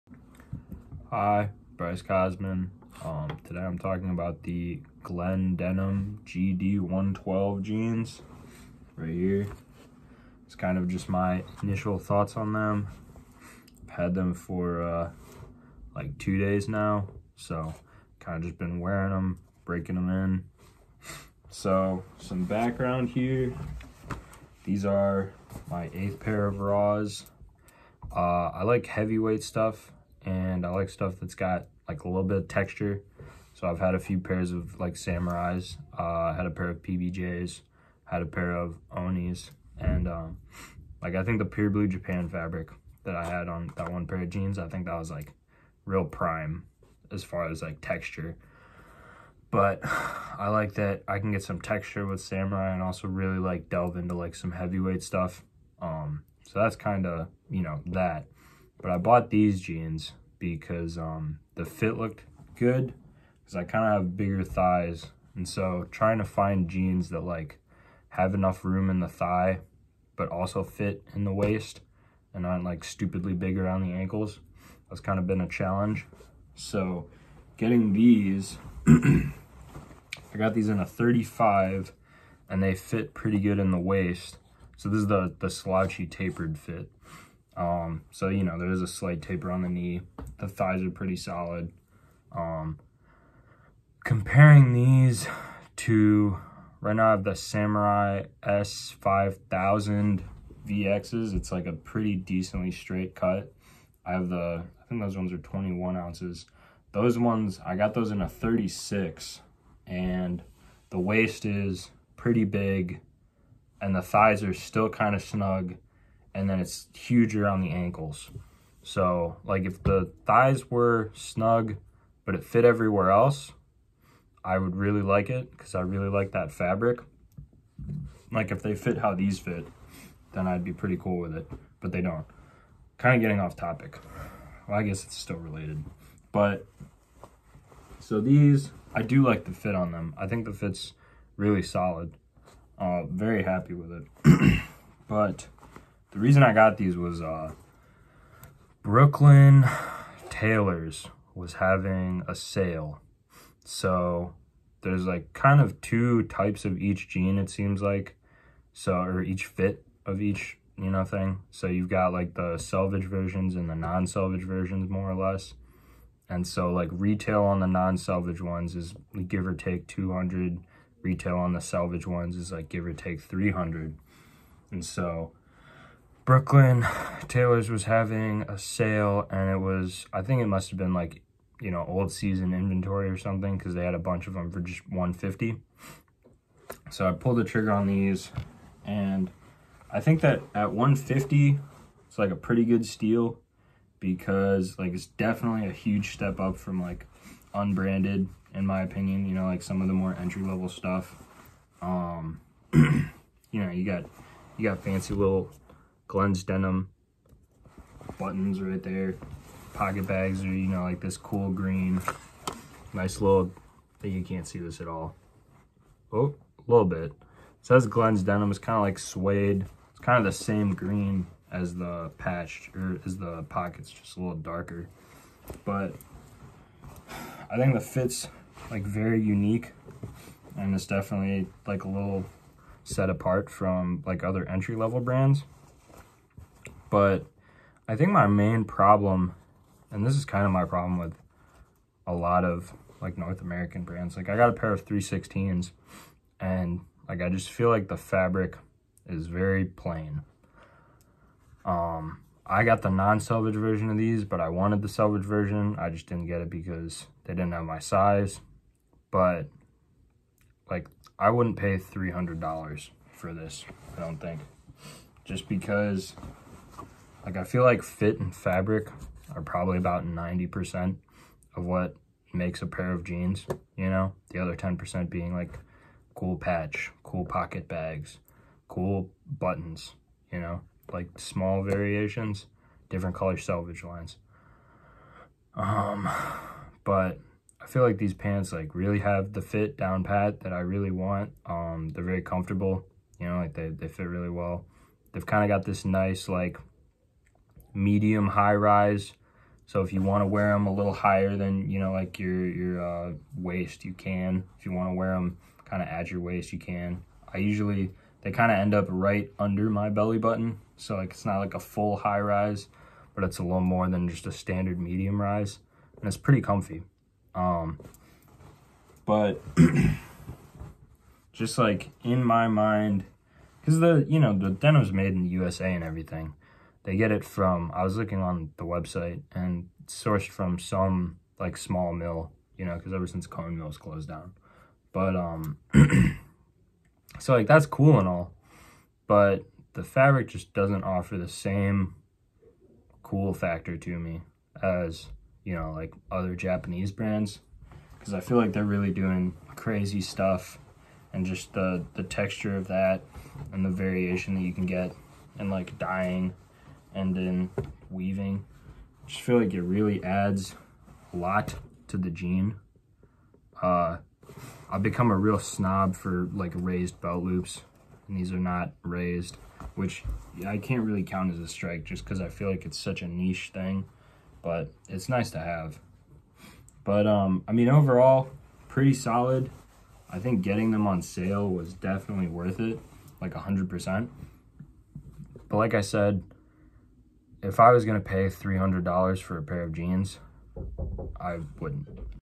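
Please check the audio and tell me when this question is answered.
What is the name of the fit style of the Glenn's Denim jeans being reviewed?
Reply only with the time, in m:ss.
1:25.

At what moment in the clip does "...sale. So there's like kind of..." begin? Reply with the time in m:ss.
2:32.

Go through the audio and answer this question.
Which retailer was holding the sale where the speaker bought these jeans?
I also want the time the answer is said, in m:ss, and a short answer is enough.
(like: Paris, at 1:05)
Brooklyn Tailors, at 2:28.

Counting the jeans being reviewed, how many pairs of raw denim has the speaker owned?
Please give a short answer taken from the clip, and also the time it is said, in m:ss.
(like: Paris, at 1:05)
8, at 0:25.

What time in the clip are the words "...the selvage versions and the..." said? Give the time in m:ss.
2:42.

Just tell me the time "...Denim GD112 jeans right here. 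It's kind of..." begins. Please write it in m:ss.
0:05.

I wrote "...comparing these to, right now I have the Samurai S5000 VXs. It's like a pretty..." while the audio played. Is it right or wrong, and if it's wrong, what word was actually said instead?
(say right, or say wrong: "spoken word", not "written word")
right.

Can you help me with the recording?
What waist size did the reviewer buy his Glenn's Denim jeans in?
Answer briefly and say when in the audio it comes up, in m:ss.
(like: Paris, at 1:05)
35, at 1:20.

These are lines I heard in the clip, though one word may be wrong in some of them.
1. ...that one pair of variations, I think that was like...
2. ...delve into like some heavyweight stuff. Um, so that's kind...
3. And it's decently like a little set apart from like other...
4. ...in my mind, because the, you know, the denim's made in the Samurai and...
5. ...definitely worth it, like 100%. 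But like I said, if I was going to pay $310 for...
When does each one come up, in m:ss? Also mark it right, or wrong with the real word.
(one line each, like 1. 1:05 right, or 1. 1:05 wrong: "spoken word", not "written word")
1. 0:43 wrong: "jeans", not "variations"
2. 0:53 right
3. 3:50 wrong: "definitely", not "decently"
4. 5:22 wrong: "USA", not "Samurai"
5. 6:21 wrong: "300", not "310".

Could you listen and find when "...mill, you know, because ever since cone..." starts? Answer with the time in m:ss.
5:31.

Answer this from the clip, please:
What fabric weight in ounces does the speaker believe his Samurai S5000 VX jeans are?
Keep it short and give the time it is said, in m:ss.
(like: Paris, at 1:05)
21 ounces, at 1:45.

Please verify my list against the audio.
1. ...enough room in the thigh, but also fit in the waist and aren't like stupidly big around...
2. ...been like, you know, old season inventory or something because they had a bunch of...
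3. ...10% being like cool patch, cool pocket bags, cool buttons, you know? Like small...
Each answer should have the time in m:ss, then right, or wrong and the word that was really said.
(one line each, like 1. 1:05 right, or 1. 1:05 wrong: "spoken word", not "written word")
1. 1:08 right
2. 3:00 right
3. 4:34 right.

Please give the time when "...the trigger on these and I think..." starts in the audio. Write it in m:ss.
3:07.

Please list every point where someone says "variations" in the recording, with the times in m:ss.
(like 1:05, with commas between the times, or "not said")
4:41, 5:53.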